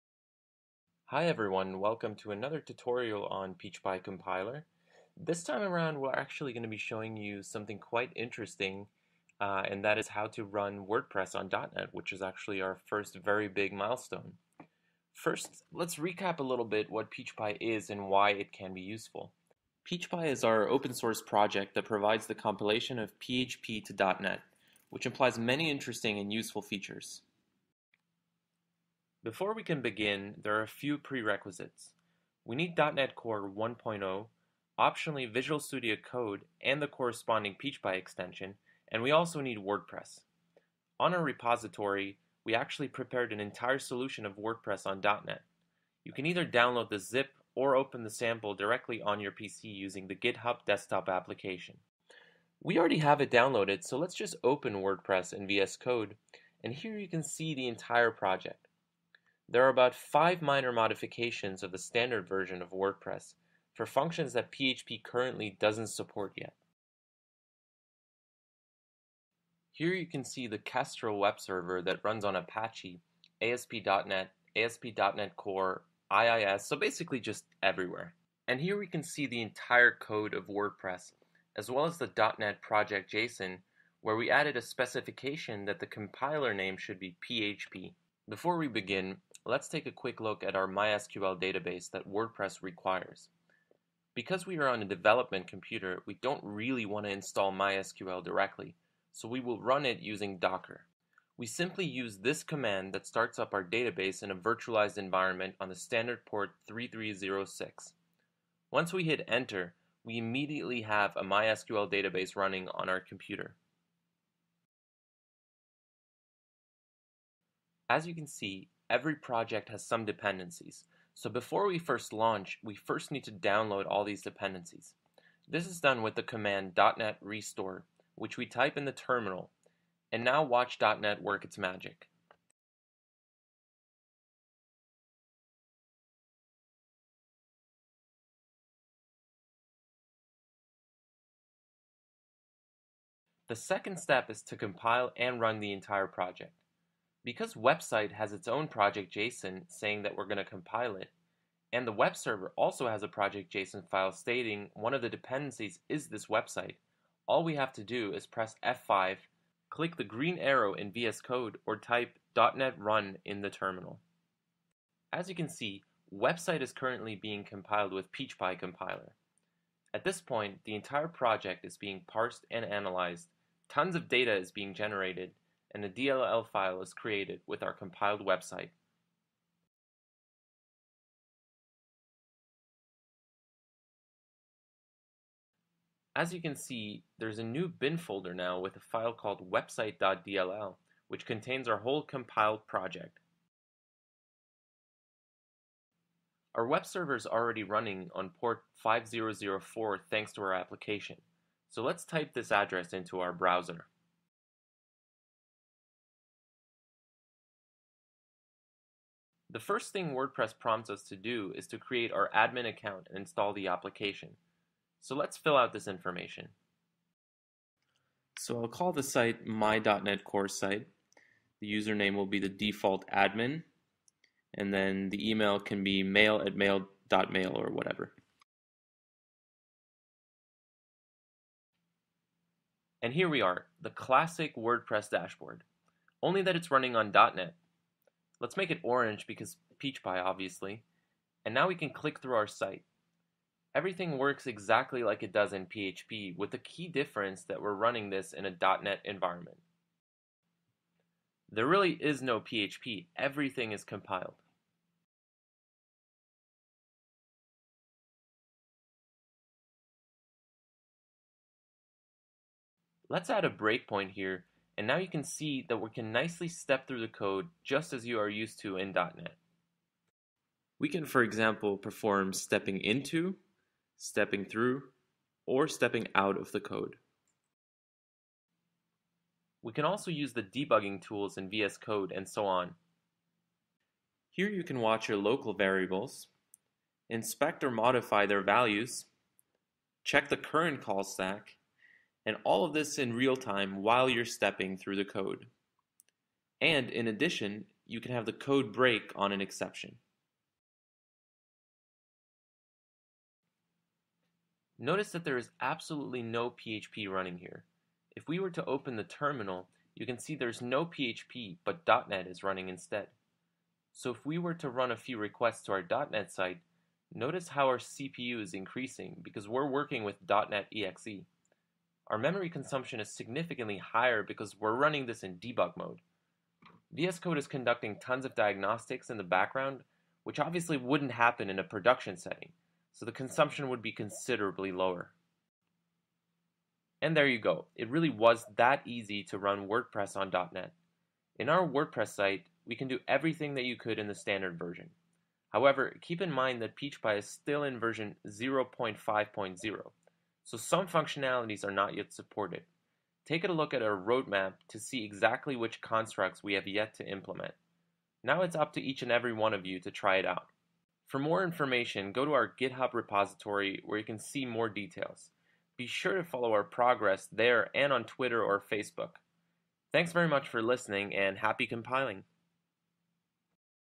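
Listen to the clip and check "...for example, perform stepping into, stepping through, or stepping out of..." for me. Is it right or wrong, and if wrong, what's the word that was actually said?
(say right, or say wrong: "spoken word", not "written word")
right.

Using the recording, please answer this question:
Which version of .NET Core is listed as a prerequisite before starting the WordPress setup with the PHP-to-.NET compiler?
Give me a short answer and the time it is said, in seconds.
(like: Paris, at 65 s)
1.0, at 33 s.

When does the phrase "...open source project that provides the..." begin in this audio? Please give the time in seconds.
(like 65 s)
20 s.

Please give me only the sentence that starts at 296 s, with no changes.
And in addition, you can have the code break on an exception.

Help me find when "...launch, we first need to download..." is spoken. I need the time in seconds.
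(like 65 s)
122 s.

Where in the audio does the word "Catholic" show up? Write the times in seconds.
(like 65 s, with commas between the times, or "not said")
not said.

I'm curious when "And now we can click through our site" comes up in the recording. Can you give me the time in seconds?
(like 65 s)
241 s.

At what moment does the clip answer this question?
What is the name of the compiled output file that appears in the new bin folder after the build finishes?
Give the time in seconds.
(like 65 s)
189 s.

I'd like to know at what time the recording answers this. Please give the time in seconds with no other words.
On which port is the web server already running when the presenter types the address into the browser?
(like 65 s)
198 s.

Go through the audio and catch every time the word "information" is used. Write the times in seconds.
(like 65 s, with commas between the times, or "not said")
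215 s, 361 s.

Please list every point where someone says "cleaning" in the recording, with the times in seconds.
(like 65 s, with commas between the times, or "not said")
not said.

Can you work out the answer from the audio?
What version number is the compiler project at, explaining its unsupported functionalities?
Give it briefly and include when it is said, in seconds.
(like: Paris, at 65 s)
0.5.0, at 348 s.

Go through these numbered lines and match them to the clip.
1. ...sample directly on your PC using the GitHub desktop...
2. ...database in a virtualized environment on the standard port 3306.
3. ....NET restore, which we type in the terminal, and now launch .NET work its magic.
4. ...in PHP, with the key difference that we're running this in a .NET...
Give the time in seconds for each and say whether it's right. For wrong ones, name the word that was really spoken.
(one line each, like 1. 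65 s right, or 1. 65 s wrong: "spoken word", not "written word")
1. 48 s right
2. 103 s right
3. 126 s wrong: "watch", not "launch"
4. 245 s right.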